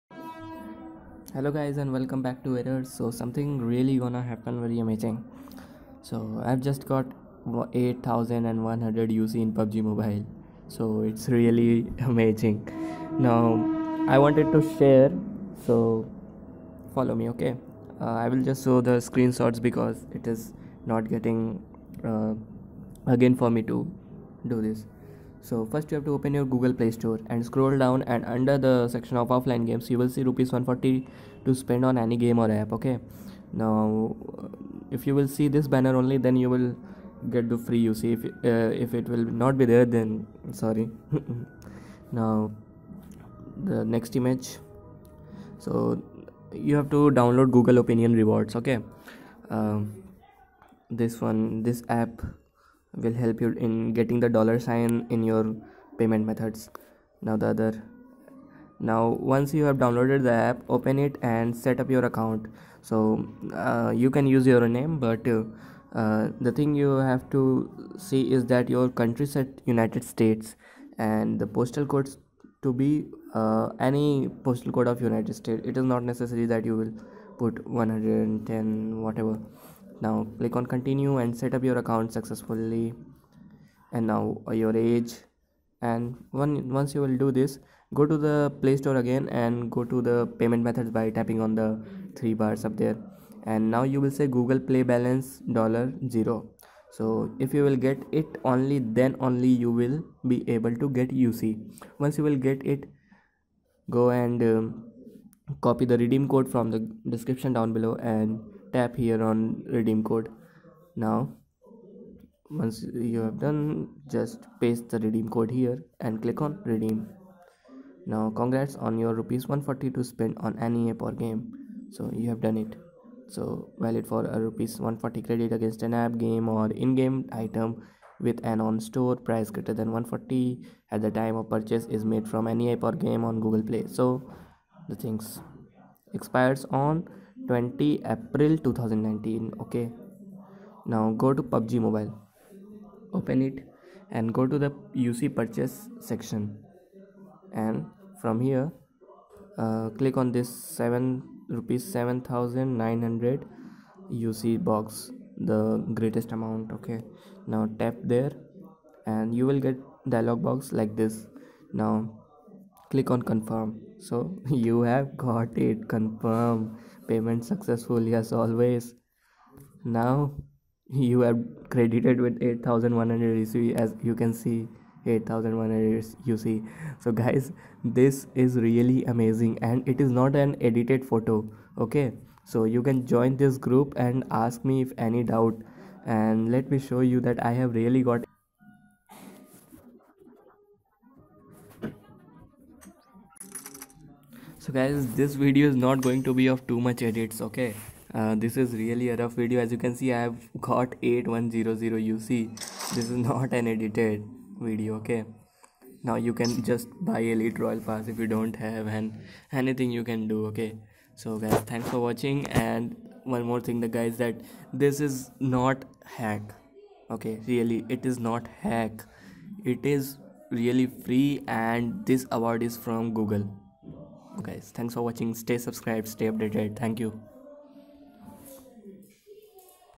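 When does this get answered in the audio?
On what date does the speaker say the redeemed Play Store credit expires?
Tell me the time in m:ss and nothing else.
2:17.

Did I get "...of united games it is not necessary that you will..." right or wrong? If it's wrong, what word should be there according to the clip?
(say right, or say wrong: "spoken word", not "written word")
wrong: "states", not "games".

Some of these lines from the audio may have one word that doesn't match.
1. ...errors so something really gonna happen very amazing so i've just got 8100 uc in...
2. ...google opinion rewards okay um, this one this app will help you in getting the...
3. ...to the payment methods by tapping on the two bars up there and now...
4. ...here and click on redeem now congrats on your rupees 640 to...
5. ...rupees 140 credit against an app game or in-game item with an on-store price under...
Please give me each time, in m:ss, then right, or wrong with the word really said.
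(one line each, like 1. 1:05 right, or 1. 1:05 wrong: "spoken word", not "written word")
1. 0:02 right
2. 0:47 right
3. 1:29 wrong: "three", not "two"
4. 1:55 wrong: "140", not "640"
5. 2:04 wrong: "greater", not "under".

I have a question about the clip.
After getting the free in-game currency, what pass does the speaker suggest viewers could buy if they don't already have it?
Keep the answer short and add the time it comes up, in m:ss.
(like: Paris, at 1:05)
Elite Royal Pass, at 3:27.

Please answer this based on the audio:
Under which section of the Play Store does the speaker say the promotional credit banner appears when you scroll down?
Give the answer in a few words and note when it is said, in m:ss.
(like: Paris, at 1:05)
Offline games, at 0:29.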